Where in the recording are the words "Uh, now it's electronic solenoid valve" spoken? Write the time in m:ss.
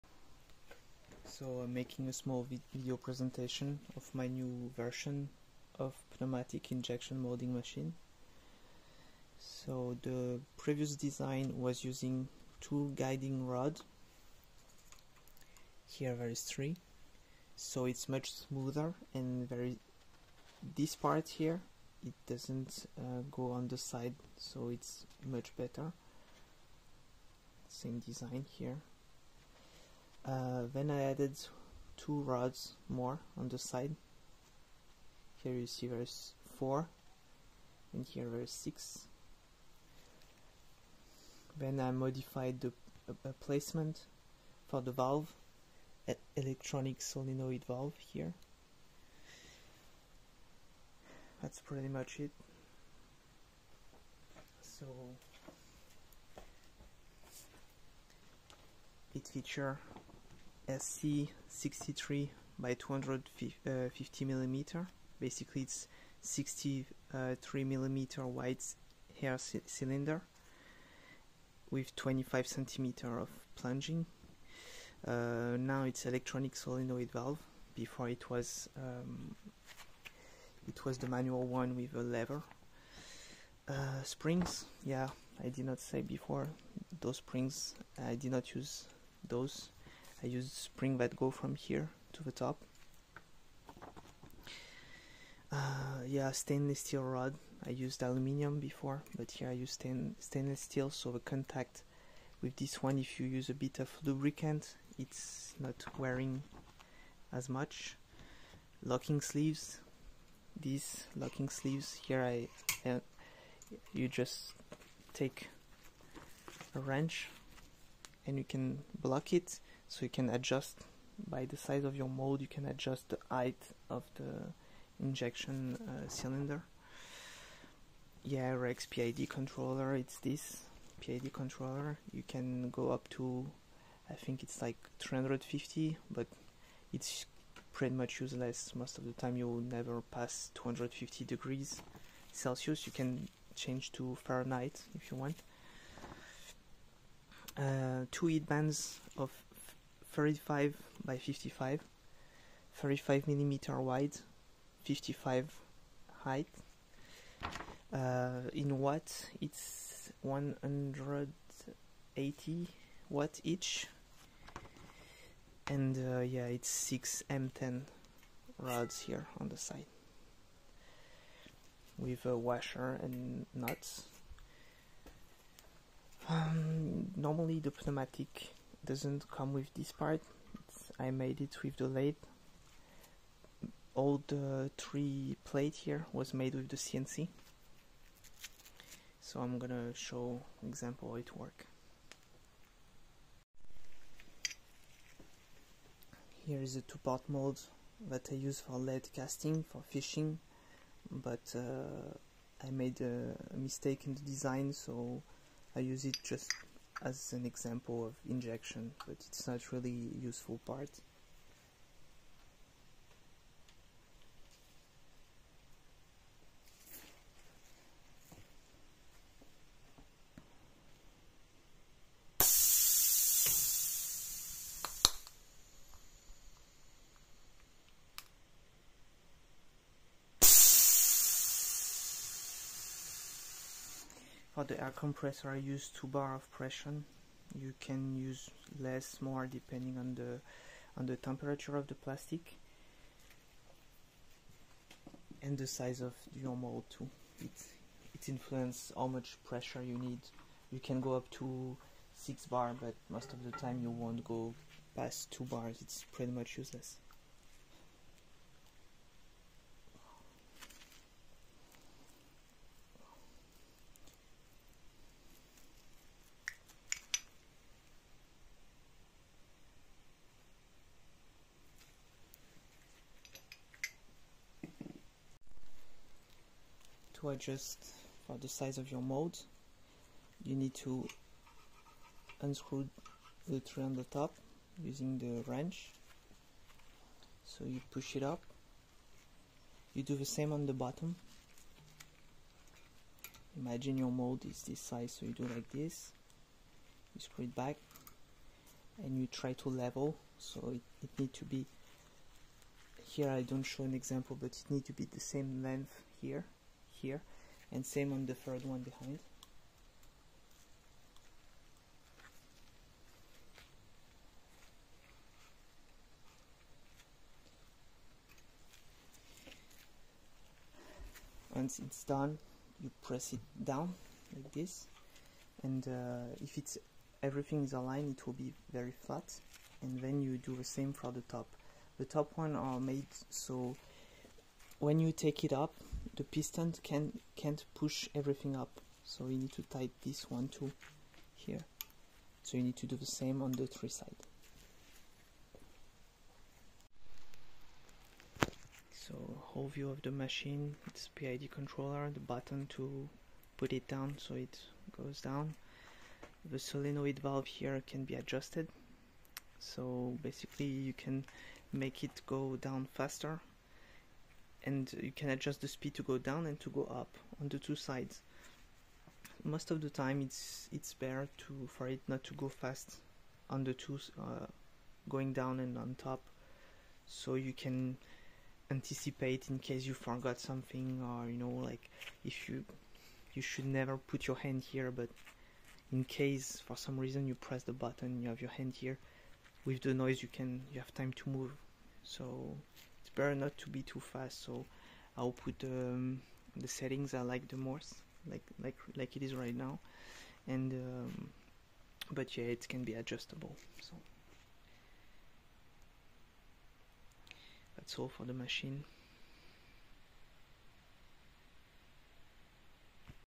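1:15.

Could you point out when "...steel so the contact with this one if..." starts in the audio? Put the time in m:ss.
1:40.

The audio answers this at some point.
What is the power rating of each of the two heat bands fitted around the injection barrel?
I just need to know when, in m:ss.
2:40.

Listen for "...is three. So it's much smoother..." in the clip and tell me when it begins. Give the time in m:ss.
0:16.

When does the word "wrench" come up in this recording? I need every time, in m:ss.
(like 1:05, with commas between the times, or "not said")
1:56, 4:45.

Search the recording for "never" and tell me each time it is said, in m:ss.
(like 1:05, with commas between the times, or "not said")
2:19, 6:23.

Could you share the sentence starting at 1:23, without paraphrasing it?
Uh, springs, yeah, I did not say before those springs.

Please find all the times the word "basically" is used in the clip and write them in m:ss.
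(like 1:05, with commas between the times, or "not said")
1:05, 6:00.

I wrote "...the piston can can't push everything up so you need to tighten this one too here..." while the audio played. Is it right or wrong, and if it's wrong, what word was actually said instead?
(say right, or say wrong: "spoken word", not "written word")
right.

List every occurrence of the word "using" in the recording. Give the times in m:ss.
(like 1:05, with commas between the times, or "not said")
0:11, 4:44.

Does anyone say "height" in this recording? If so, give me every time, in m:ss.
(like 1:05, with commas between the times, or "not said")
2:03, 2:36.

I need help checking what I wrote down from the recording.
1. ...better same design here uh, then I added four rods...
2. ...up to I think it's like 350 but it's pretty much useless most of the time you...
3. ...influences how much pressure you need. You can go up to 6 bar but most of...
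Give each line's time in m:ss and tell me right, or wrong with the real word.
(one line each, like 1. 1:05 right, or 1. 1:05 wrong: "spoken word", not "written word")
1. 0:25 wrong: "two", not "four"
2. 2:12 right
3. 4:08 right.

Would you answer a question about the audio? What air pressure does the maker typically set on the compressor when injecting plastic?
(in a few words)
2 bar.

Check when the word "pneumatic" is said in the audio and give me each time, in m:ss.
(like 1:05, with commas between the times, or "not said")
0:06, 2:57.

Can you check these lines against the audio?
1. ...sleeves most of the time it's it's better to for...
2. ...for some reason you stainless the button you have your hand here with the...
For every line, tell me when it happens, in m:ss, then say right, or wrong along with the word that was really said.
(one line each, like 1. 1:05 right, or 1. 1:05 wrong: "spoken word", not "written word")
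1. 6:07 wrong: "sides", not "sleeves"
2. 6:26 wrong: "press", not "stainless".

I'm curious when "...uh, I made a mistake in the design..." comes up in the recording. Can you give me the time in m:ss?
3:21.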